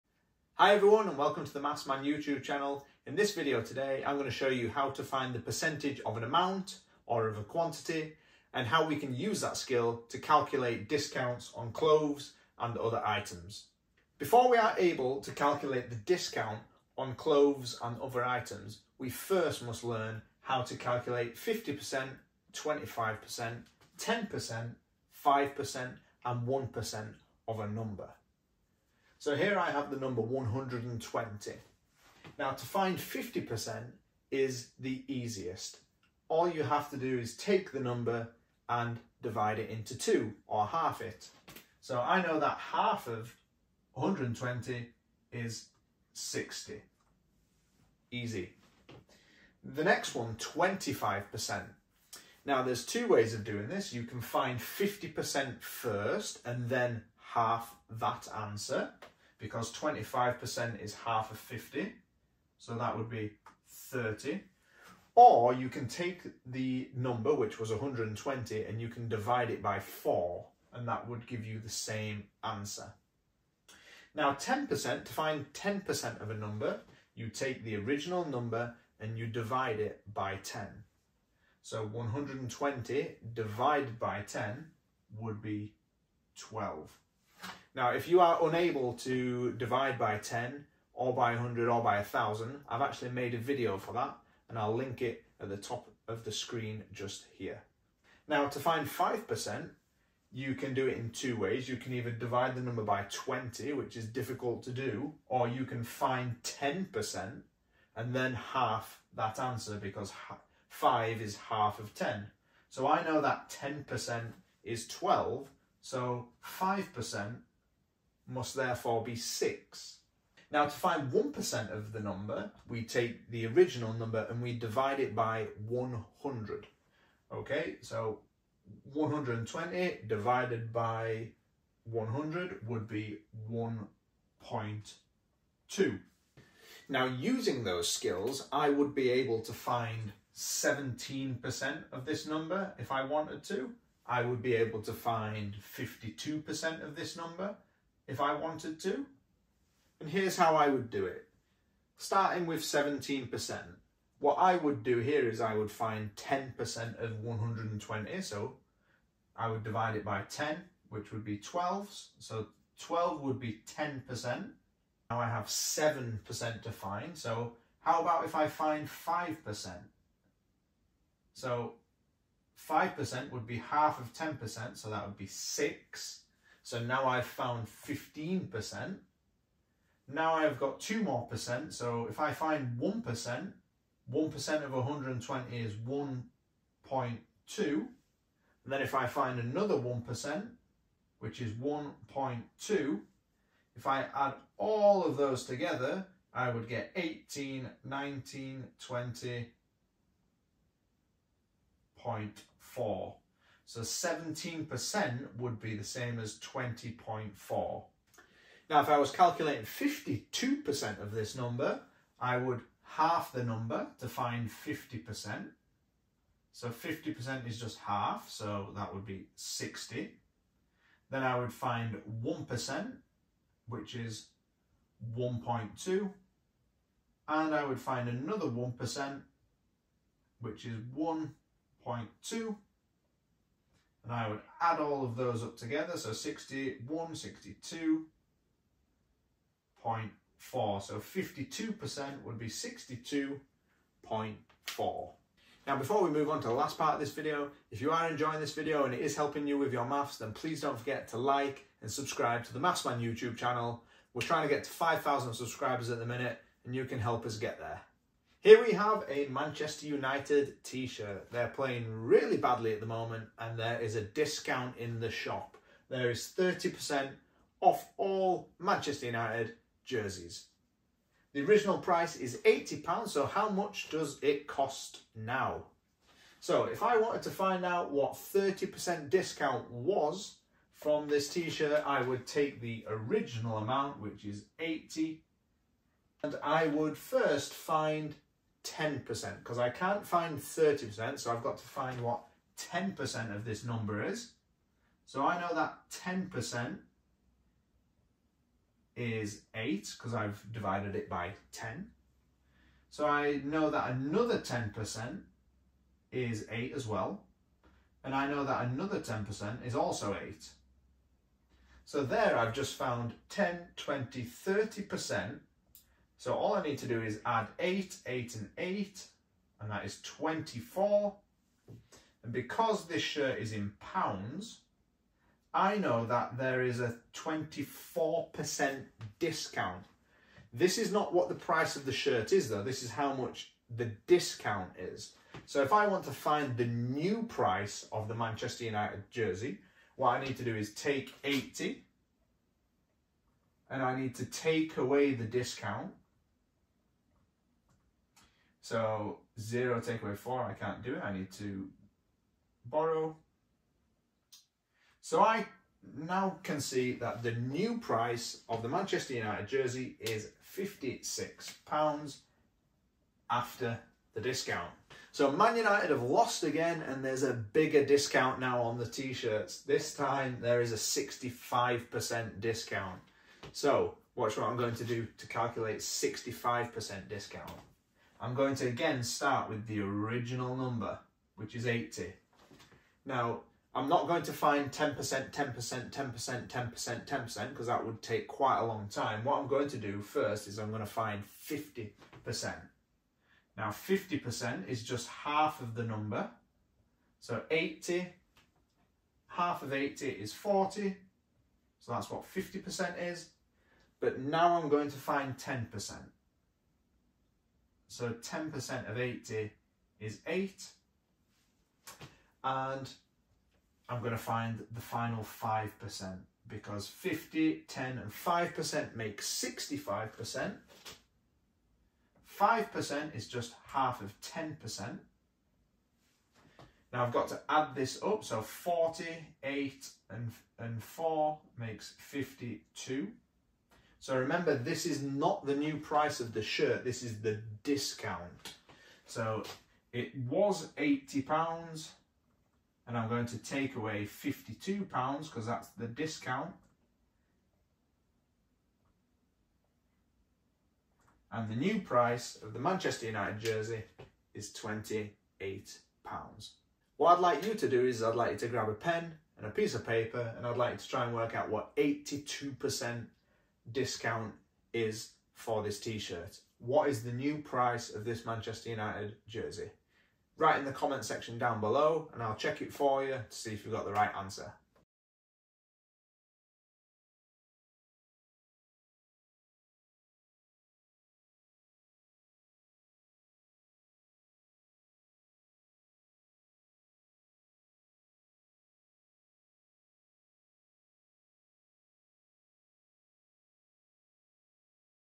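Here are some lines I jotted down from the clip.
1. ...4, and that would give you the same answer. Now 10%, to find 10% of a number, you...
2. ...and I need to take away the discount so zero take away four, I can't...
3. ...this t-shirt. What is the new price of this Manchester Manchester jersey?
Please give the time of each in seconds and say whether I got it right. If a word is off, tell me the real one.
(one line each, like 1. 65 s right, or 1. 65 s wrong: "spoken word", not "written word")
1. 69 s right
2. 343 s right
3. 465 s wrong: "United", not "Manchester".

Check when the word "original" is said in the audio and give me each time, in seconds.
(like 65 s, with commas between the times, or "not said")
77 s, 123 s, 271 s, 282 s, 379 s.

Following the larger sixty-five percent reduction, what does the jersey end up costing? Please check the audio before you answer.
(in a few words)
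£28.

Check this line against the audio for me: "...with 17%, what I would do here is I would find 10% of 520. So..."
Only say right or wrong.
wrong.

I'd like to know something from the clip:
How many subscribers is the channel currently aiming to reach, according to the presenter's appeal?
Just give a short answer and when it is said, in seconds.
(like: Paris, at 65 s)
5,000, at 254 s.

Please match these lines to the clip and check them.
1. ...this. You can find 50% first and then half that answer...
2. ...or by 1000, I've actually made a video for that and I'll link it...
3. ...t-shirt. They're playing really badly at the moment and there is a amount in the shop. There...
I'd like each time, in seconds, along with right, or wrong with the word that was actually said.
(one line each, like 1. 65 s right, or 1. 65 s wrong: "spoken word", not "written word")
1. 53 s right
2. 91 s right
3. 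260 s wrong: "discount", not "amount".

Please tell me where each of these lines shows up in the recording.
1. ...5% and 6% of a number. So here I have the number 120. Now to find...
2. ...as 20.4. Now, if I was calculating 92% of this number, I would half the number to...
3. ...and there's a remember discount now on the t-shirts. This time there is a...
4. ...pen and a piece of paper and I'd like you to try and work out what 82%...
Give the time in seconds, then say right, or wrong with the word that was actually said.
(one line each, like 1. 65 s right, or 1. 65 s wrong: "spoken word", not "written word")
1. 25 s wrong: "1", not "6"
2. 206 s wrong: "52", not "92"
3. 366 s wrong: "bigger", not "remember"
4. 458 s right.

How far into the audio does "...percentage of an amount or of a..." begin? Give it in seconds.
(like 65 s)
5 s.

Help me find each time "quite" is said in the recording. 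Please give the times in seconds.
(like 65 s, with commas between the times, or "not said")
388 s.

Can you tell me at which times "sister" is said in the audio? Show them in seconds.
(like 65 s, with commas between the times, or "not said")
not said.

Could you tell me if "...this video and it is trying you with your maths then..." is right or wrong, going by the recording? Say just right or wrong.
wrong.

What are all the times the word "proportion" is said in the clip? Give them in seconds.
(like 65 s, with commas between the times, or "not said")
not said.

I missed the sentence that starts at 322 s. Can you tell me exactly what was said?
And because this shirt is in pounds, I know that there is a 24% discount.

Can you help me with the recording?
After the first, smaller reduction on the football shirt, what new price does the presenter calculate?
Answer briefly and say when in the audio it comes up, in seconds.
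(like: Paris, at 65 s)
£56, at 360 s.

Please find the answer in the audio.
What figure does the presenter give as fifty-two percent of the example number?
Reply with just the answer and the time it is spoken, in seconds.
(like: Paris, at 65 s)
62.4, at 242 s.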